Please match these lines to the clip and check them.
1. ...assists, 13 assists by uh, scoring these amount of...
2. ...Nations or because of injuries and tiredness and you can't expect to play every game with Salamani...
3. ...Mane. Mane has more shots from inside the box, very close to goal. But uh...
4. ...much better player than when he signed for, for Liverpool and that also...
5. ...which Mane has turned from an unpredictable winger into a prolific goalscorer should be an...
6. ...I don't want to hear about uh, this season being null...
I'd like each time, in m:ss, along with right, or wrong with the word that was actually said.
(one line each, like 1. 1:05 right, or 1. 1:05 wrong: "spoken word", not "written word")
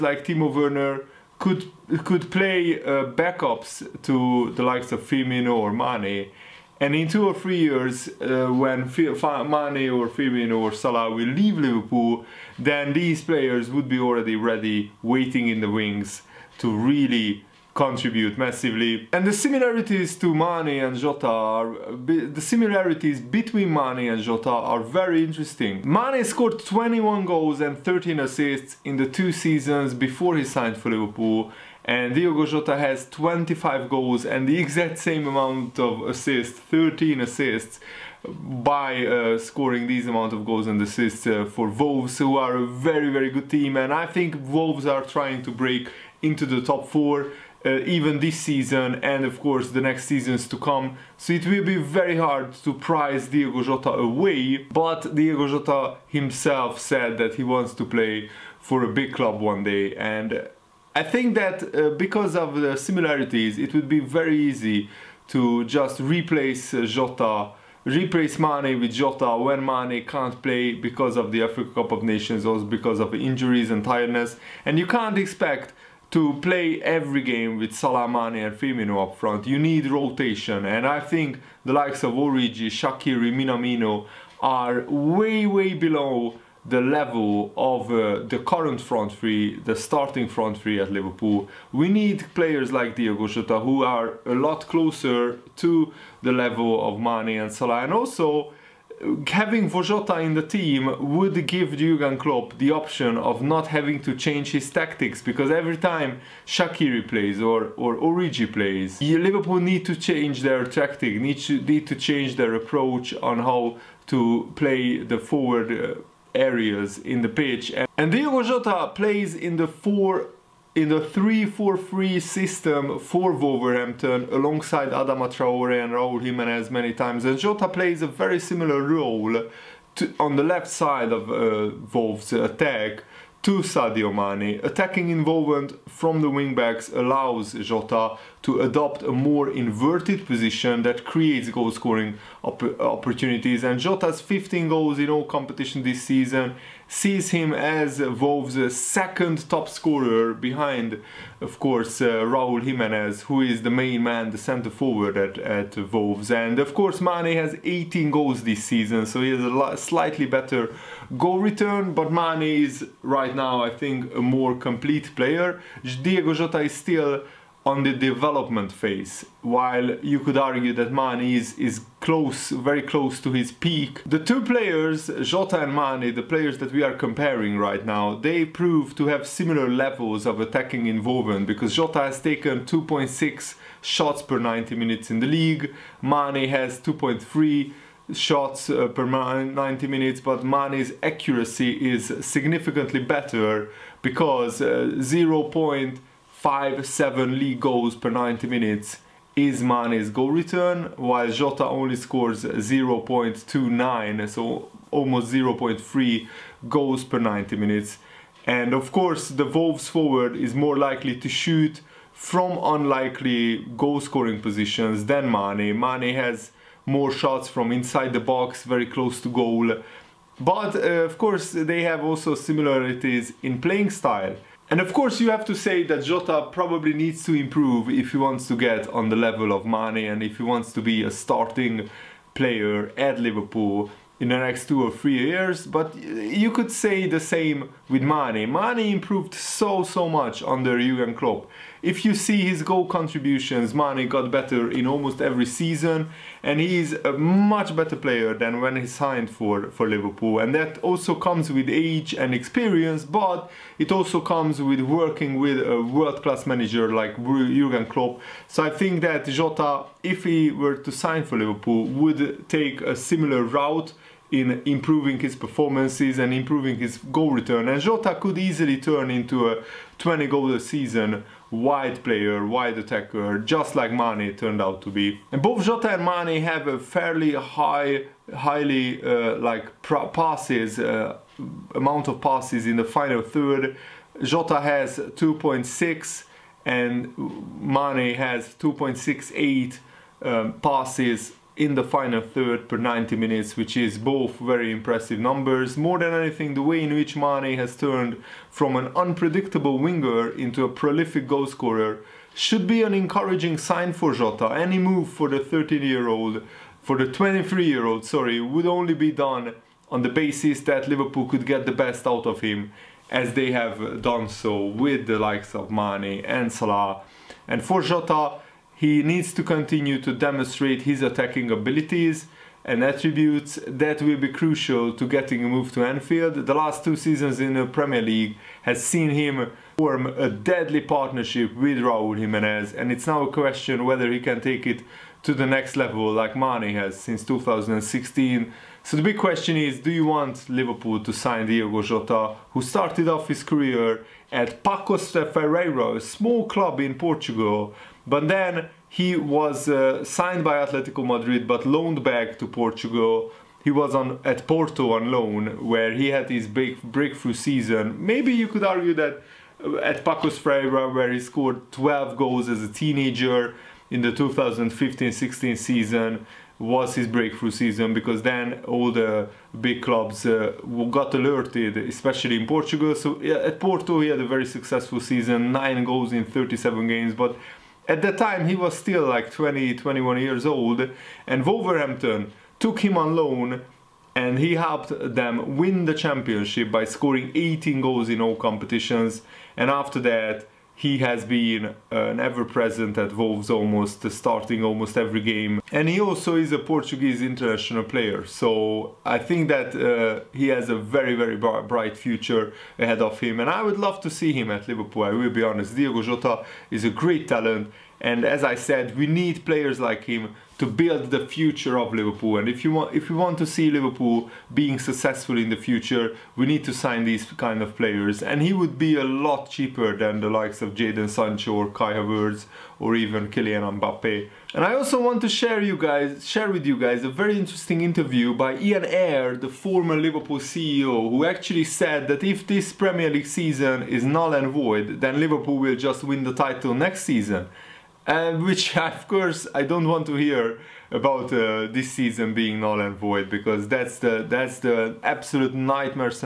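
1. 0:36 right
2. 1:12 right
3. 3:35 right
4. 4:07 right
5. 4:56 right
6. 7:19 right.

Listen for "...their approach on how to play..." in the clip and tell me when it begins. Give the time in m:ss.
1:52.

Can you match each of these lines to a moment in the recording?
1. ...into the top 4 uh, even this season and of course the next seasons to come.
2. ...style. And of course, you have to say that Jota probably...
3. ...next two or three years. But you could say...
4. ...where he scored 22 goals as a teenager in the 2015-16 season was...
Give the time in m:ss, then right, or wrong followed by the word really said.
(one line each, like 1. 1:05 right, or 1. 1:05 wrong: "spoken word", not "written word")
1. 0:46 right
2. 3:43 right
3. 3:54 right
4. 6:00 wrong: "12", not "22".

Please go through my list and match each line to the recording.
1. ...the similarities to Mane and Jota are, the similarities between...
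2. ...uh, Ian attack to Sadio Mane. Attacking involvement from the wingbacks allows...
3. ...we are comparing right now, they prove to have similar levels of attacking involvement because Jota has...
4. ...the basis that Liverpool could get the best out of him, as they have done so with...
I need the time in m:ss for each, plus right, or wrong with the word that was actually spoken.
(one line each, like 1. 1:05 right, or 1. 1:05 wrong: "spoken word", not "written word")
1. 0:19 right
2. 2:11 wrong: "Wolves", not "Ian"
3. 2:56 right
4. 5:10 right.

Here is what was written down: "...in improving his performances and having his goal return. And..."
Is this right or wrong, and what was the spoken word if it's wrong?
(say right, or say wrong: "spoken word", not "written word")
wrong: "improving", not "having".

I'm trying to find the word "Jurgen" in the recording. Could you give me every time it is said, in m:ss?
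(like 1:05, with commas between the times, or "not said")
1:41, 4:00, 4:17.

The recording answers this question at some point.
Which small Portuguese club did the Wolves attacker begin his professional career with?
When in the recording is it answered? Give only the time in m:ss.
5:44.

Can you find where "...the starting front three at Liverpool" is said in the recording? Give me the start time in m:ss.
1:29.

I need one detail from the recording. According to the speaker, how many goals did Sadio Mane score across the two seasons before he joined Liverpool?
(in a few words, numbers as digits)
21.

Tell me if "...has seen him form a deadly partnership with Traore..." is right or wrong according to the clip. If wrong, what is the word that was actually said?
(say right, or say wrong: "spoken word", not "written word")
wrong: "Raul", not "Traore".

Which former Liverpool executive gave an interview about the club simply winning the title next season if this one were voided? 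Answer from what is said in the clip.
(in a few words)
Ian Ayre.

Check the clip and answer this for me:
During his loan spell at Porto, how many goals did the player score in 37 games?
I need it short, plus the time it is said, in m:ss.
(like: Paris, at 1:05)
9, at 6:15.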